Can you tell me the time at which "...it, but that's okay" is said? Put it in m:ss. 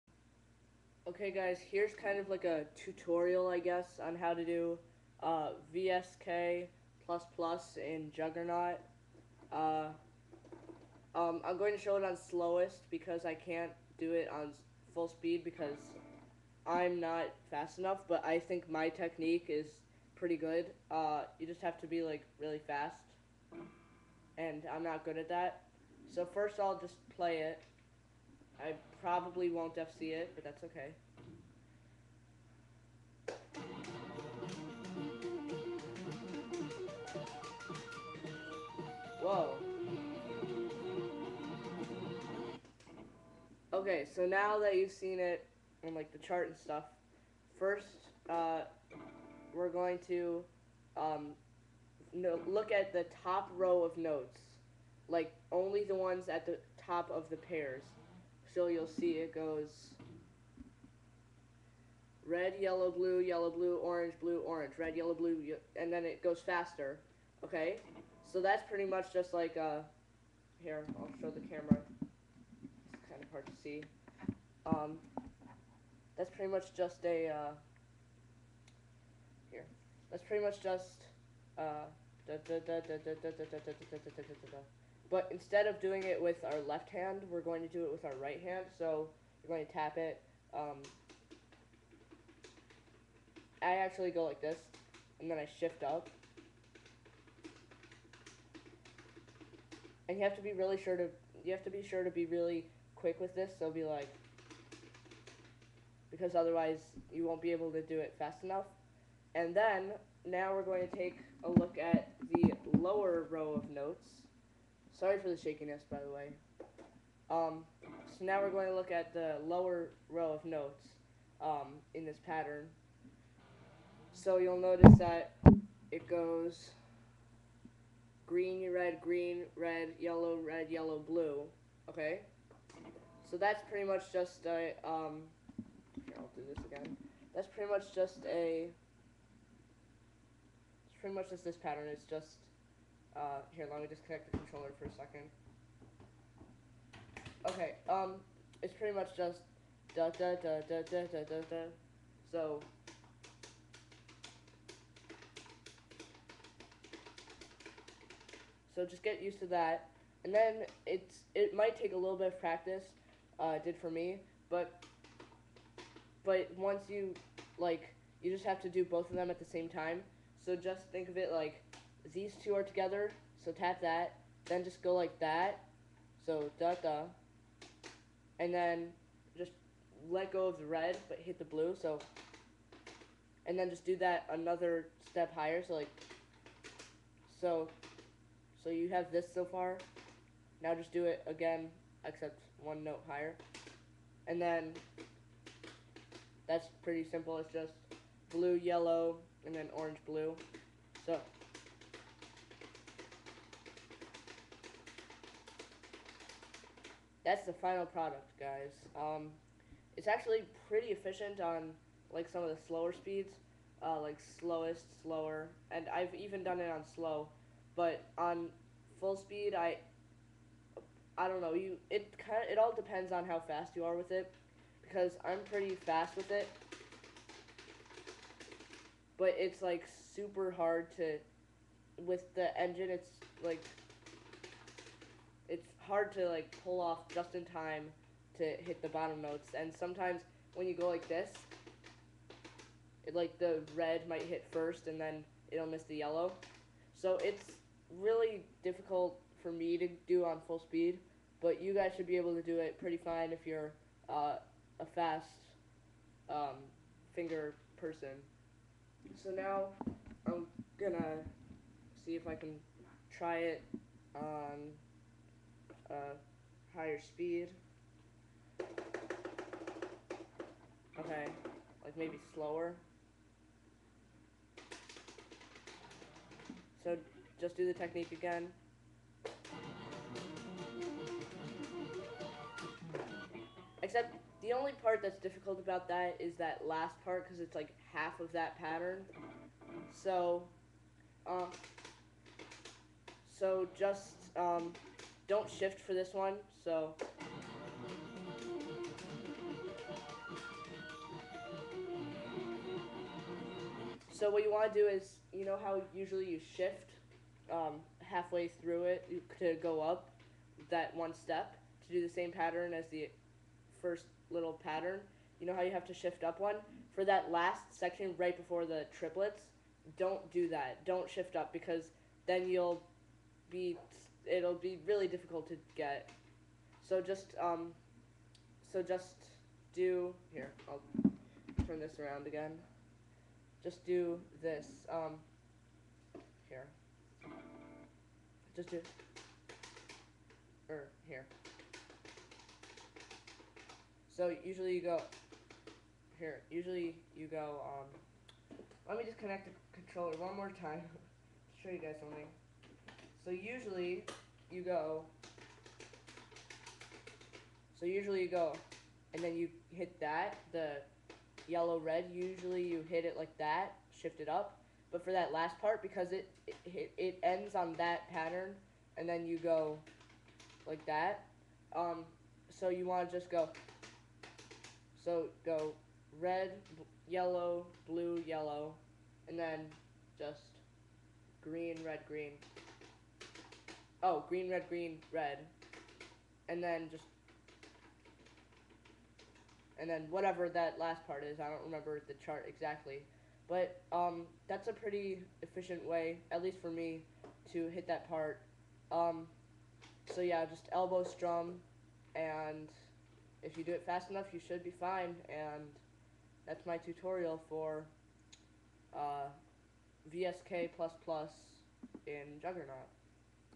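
0:30.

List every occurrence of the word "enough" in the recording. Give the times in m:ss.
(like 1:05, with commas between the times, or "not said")
0:17, 1:48, 6:44.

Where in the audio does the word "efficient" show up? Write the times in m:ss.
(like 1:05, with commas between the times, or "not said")
3:30, 6:35.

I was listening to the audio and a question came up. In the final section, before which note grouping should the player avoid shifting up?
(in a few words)
Triplets.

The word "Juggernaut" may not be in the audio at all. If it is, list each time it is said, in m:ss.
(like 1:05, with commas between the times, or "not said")
0:08, 6:52.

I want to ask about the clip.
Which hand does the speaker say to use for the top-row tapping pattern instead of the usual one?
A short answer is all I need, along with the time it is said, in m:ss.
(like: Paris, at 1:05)
Right hand, at 1:28.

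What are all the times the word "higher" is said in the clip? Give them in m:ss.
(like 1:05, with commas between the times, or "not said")
3:05, 3:13, 4:26.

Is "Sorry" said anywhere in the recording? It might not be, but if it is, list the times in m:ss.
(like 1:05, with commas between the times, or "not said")
1:55.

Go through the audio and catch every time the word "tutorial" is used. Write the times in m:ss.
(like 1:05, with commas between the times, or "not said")
0:02, 6:46.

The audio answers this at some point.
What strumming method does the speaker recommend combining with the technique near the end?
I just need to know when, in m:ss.
6:40.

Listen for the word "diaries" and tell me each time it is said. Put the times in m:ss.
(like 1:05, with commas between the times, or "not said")
not said.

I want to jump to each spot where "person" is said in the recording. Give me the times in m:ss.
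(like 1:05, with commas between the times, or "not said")
4:17.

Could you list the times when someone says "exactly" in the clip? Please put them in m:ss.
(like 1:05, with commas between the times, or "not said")
6:32.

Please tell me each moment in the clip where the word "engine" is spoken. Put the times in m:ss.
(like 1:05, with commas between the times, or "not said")
3:52.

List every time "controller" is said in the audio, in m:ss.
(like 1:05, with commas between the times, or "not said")
2:24, 5:49.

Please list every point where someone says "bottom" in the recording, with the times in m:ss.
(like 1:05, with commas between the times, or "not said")
3:58.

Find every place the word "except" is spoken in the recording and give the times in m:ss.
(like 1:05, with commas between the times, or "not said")
3:12, 4:43.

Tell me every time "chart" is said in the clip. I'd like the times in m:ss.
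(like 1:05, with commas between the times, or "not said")
0:46, 6:32.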